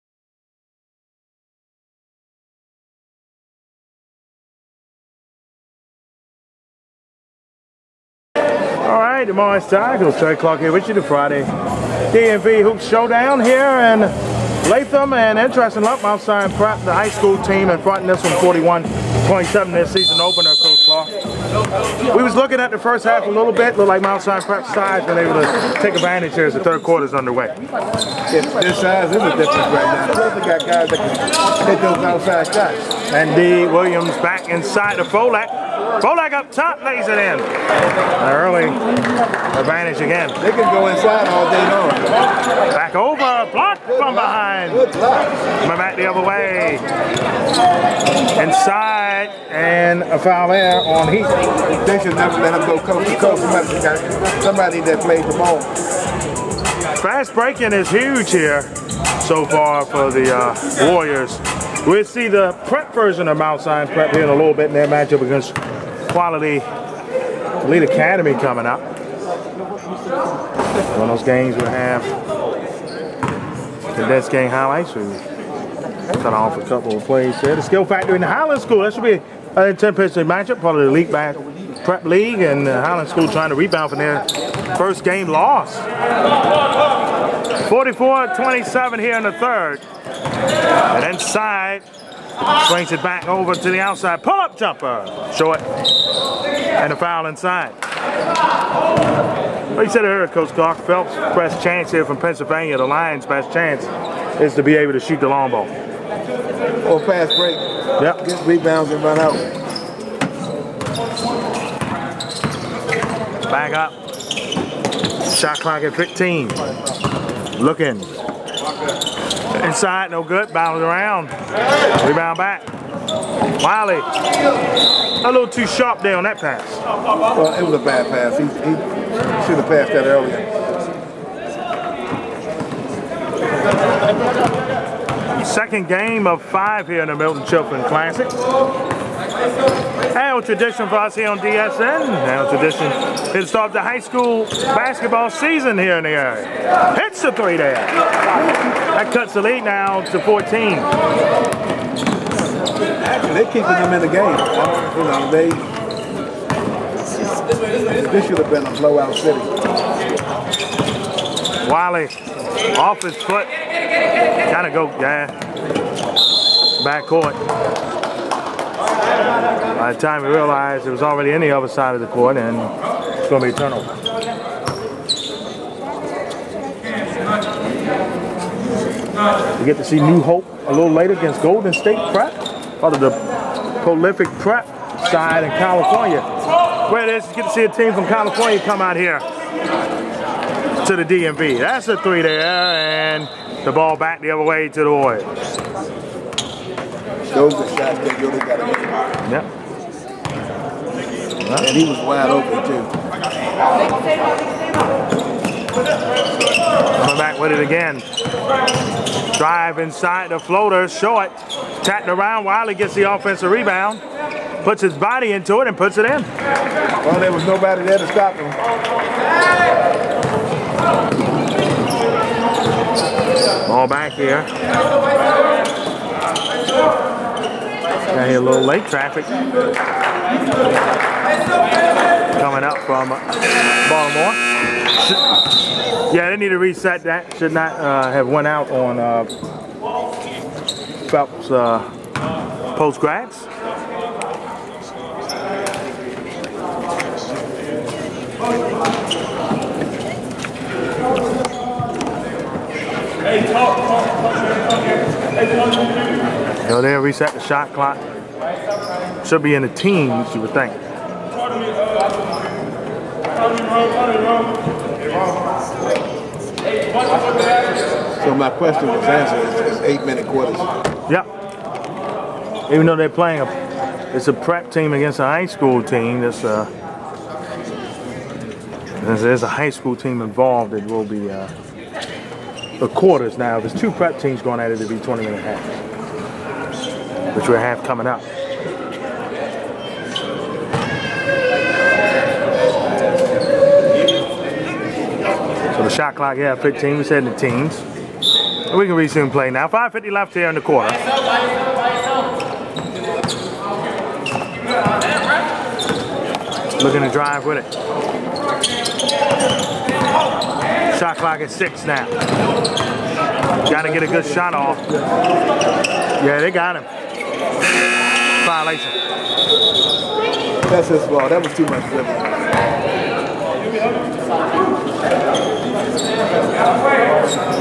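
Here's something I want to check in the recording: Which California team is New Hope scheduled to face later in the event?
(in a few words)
Golden State Prep.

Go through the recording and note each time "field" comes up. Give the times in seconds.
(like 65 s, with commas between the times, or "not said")
not said.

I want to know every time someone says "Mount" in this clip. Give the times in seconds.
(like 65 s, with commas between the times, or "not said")
24 s, 63 s.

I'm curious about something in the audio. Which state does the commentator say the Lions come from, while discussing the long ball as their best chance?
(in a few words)
Pennsylvania.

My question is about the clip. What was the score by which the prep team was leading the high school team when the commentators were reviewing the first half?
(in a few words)
41-27.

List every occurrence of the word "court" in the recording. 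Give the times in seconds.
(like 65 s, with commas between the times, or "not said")
167 s, 172 s.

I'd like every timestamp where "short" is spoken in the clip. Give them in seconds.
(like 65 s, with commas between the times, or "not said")
95 s, 210 s.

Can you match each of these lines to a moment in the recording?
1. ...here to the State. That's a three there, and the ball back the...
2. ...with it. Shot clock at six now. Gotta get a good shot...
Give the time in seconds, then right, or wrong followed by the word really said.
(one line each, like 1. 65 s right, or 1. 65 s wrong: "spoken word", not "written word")
1. 188 s wrong: "DMV", not "State"
2. 307 s right.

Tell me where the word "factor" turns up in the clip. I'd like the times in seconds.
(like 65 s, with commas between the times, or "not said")
77 s.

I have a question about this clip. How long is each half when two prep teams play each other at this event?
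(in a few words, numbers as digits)
20 minutes.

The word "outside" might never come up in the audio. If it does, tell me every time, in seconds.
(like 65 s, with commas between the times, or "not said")
16 s, 32 s, 93 s.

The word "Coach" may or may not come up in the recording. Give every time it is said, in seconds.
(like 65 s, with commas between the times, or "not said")
20 s, 100 s.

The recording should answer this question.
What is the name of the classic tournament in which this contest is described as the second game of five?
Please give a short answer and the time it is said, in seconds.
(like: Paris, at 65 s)
Myrtle Chaffin Classic, at 137 s.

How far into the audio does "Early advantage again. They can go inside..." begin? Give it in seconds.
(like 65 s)
38 s.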